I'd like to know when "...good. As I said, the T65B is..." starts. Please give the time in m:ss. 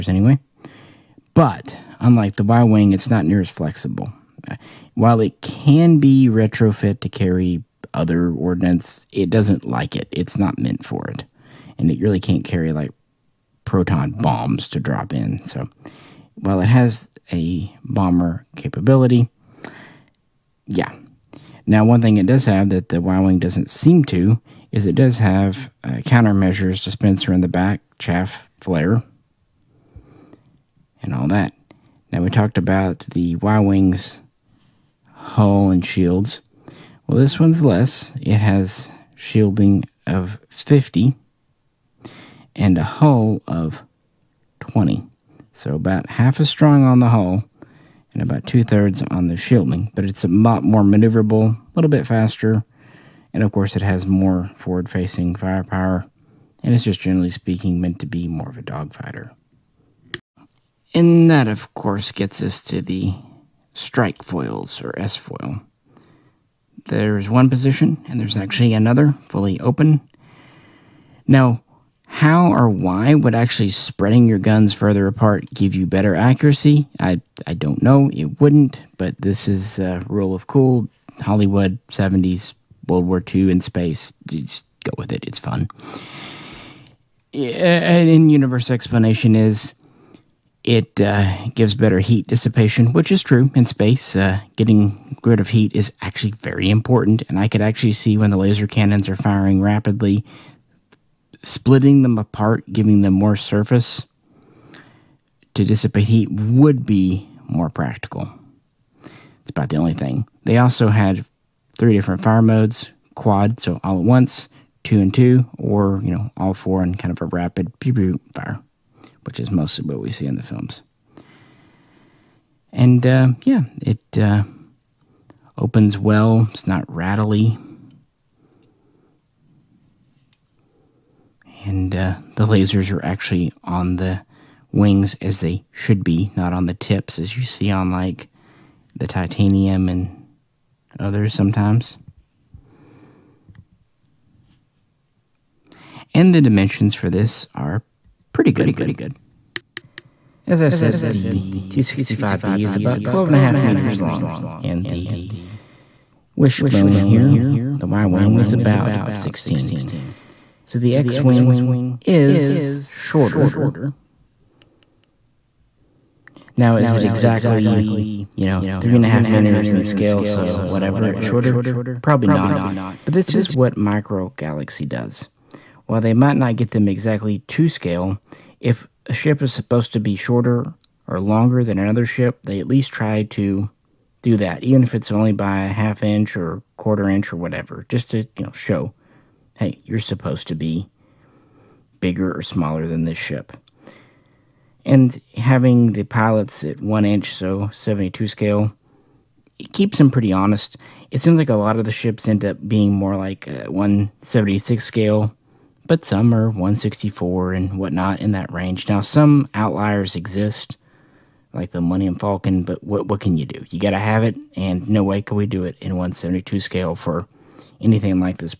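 2:28.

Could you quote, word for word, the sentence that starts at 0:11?
And it really can't carry, like, proton bombs to drop in.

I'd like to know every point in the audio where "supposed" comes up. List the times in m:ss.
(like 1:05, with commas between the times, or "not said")
2:59, 3:09.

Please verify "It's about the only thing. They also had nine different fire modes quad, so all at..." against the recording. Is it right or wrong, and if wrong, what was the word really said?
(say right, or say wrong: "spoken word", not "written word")
wrong: "three", not "nine".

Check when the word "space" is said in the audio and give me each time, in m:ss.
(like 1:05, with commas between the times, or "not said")
1:23, 1:33.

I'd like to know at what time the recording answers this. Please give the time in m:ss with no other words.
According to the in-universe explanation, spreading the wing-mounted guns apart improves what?
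1:31.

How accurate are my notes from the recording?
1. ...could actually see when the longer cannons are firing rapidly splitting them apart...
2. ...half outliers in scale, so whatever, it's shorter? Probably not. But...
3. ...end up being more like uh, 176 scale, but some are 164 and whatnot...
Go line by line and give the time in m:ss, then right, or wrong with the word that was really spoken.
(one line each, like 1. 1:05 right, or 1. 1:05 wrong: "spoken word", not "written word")
1. 1:37 wrong: "laser", not "longer"
2. 2:49 wrong: "meters", not "outliers"
3. 3:22 right.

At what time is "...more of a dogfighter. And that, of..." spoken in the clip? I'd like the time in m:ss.
0:58.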